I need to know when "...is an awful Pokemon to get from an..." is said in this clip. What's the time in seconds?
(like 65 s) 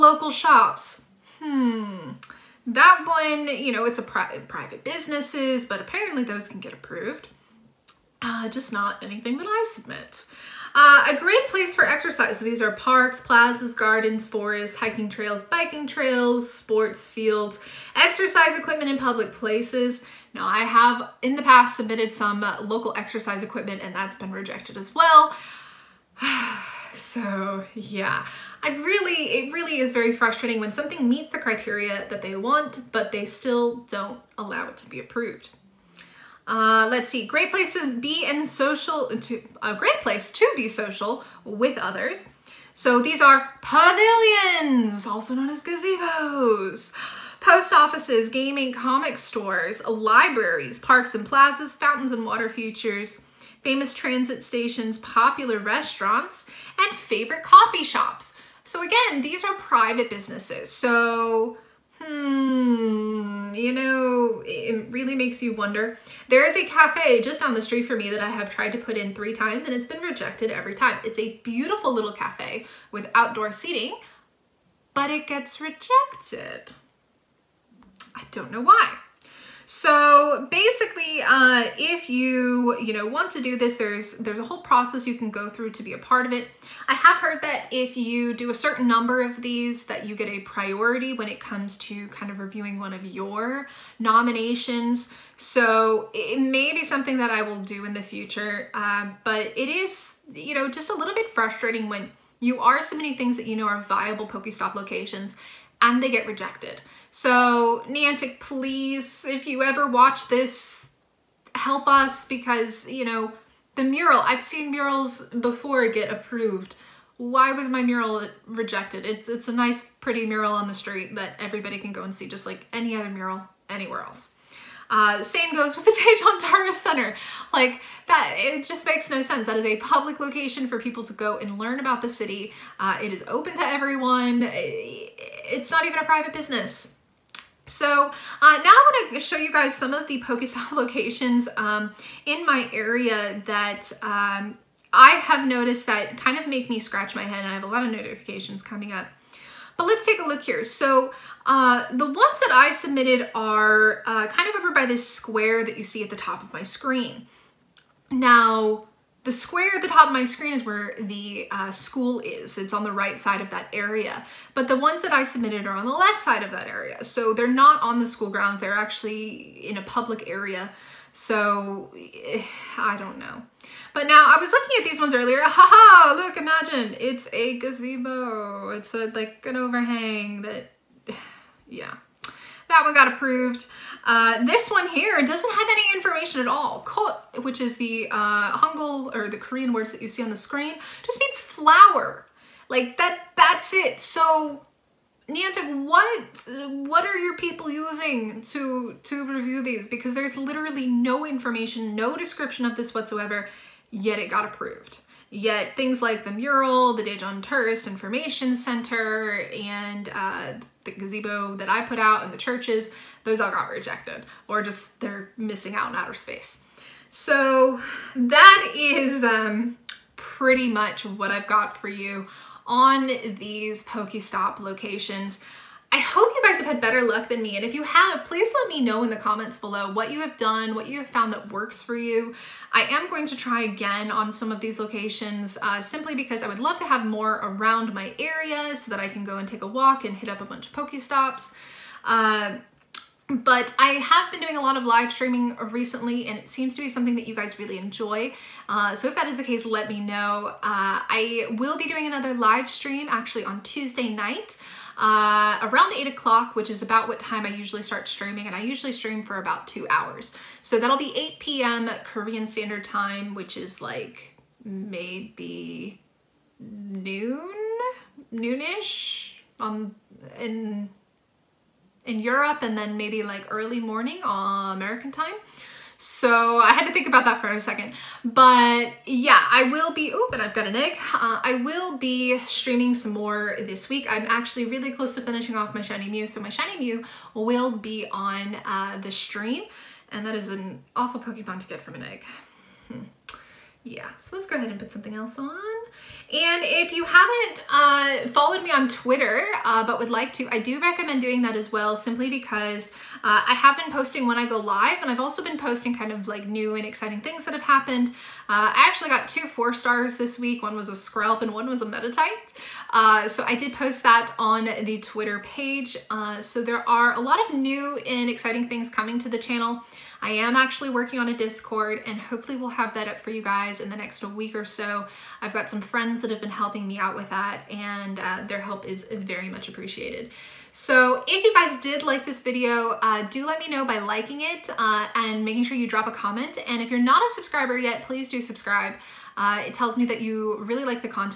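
290 s.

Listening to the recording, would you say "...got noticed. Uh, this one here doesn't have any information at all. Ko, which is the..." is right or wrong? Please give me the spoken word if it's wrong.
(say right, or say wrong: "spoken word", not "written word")
wrong: "approved", not "noticed".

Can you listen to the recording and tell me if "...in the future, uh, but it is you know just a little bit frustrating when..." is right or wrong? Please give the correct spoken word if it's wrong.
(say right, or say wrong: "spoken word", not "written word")
right.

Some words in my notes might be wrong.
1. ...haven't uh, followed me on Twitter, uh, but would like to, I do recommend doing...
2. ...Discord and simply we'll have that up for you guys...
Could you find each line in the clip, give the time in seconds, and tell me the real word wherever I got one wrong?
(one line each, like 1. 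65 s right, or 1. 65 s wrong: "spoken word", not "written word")
1. 297 s right
2. 321 s wrong: "hopefully", not "simply".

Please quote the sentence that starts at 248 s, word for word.
Uh, so if that is the case, let me know.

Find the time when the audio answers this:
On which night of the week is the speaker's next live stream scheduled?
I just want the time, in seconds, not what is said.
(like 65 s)
253 s.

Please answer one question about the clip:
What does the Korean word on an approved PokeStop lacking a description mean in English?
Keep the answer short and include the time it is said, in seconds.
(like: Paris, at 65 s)
flower, at 191 s.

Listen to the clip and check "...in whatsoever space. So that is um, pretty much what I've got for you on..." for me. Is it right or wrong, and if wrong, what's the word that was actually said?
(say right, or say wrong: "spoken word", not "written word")
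wrong: "outer", not "whatsoever".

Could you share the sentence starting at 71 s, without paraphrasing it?
It's a beautiful little cafe with outdoor seating, but it gets rejected.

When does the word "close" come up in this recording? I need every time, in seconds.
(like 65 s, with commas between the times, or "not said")
284 s.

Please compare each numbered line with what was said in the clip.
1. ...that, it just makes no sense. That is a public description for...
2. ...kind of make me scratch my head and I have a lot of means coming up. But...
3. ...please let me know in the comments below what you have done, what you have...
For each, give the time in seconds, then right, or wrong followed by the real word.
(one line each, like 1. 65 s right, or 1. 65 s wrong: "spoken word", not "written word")
1. 128 s wrong: "location", not "description"
2. 146 s wrong: "notifications", not "means"
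3. 228 s right.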